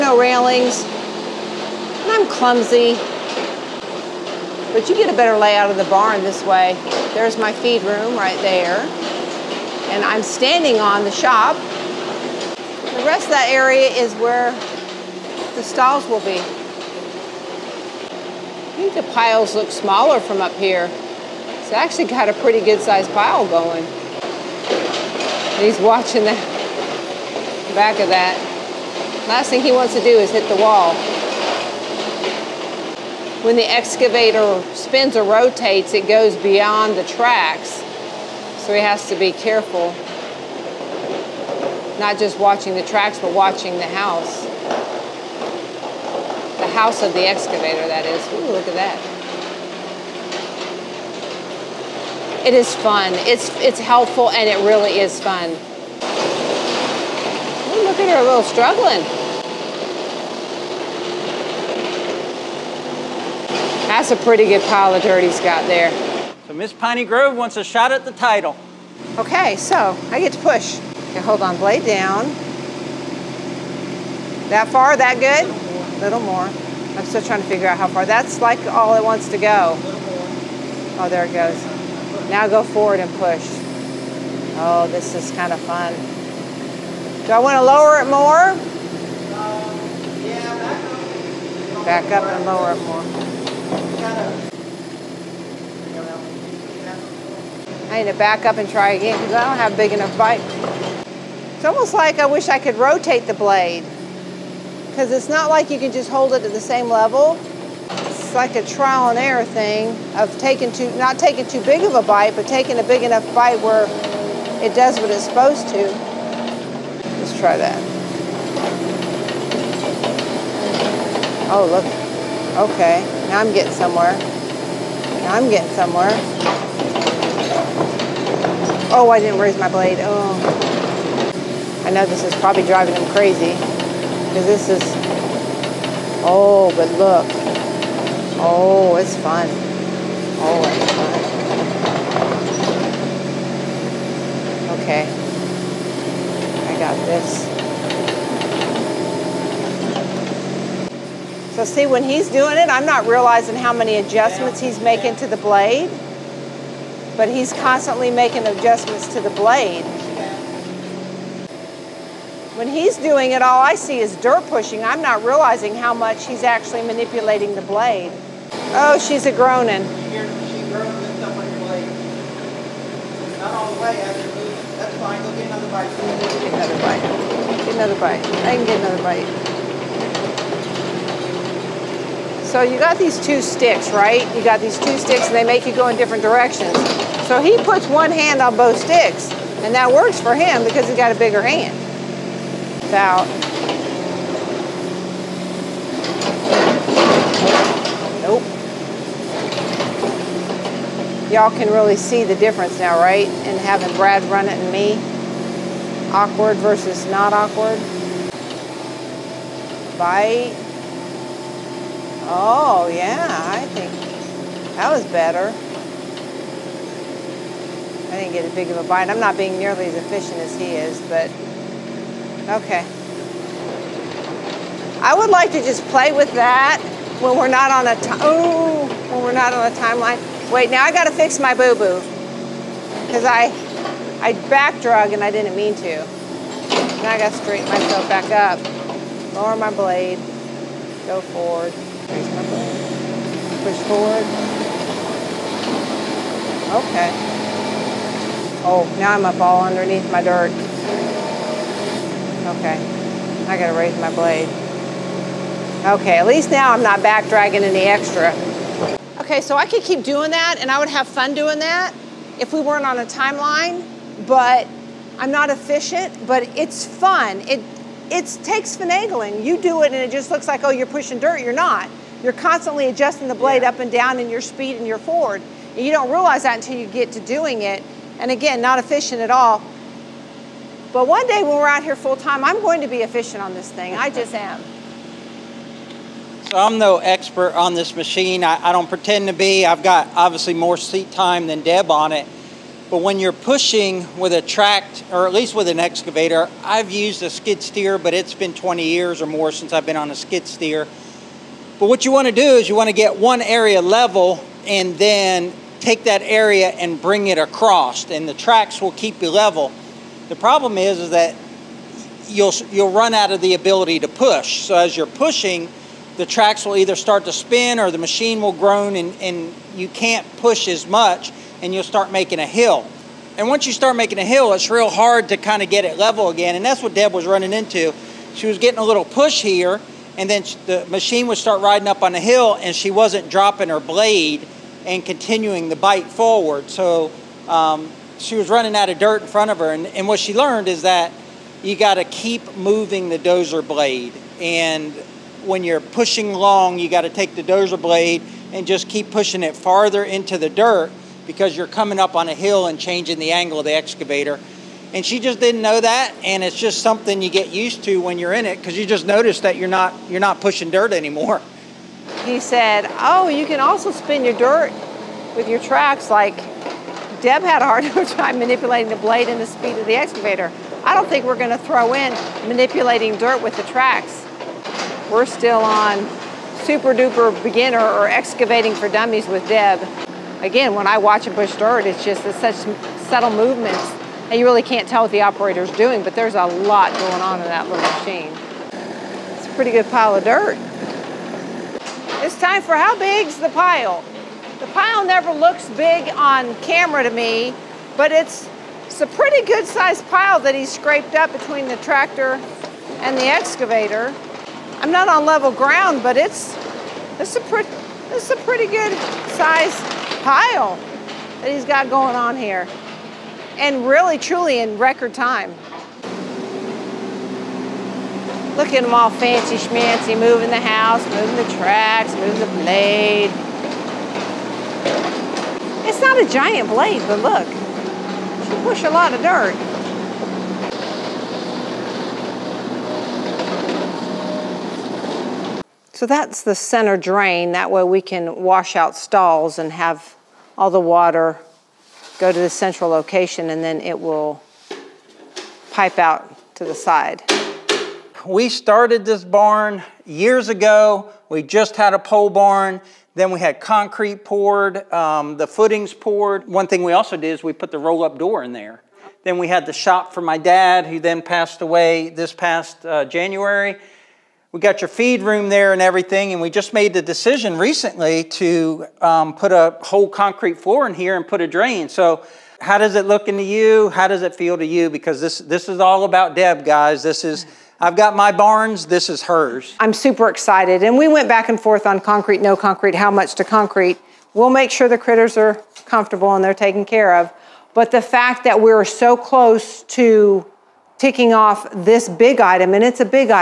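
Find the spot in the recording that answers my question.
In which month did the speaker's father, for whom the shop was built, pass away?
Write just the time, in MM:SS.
07:43.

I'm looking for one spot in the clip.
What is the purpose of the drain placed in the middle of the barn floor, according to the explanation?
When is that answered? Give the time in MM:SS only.
07:18.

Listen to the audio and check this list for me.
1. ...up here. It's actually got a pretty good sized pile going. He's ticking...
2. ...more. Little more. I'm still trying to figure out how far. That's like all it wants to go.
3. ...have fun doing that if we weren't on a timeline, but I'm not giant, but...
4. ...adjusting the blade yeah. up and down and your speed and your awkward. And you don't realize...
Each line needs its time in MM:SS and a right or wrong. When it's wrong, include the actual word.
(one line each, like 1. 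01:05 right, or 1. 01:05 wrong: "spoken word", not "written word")
1. 00:20 wrong: "watching", not "ticking"
2. 01:16 right
3. 04:20 wrong: "efficient", not "giant"
4. 04:32 wrong: "forward", not "awkward".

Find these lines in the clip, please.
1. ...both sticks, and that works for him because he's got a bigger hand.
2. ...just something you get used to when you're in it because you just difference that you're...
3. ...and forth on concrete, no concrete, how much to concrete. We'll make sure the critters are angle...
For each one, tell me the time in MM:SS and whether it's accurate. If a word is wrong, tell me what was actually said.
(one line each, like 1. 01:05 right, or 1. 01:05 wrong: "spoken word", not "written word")
1. 03:08 right
2. 05:56 wrong: "notice", not "difference"
3. 08:01 wrong: "comfortable", not "angle".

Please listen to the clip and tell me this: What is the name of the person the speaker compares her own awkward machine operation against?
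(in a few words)
Brad.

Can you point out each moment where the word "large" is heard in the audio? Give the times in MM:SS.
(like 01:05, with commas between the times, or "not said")
not said.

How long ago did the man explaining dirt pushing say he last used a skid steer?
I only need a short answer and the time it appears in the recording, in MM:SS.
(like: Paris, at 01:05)
20 years or more, at 04:58.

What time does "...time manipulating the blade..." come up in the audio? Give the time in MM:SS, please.
06:08.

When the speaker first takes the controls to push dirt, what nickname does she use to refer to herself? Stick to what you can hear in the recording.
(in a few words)
Miss Piney Grove.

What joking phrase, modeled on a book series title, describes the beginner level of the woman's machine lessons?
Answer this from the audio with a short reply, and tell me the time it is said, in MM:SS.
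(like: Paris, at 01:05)
Excavating for dummies, at 06:18.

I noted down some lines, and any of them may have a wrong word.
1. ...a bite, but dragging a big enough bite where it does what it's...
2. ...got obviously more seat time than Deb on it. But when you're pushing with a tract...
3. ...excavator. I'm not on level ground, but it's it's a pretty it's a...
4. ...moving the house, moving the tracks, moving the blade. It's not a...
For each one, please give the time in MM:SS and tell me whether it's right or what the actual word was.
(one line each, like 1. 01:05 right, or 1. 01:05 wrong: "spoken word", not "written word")
1. 01:51 wrong: "taking", not "dragging"
2. 04:49 right
3. 06:43 right
4. 07:00 right.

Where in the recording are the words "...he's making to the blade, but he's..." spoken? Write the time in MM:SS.
02:34.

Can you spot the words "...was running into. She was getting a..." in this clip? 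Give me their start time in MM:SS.
05:27.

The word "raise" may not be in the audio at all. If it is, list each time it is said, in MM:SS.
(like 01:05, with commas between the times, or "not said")
02:09, 04:01, 04:13.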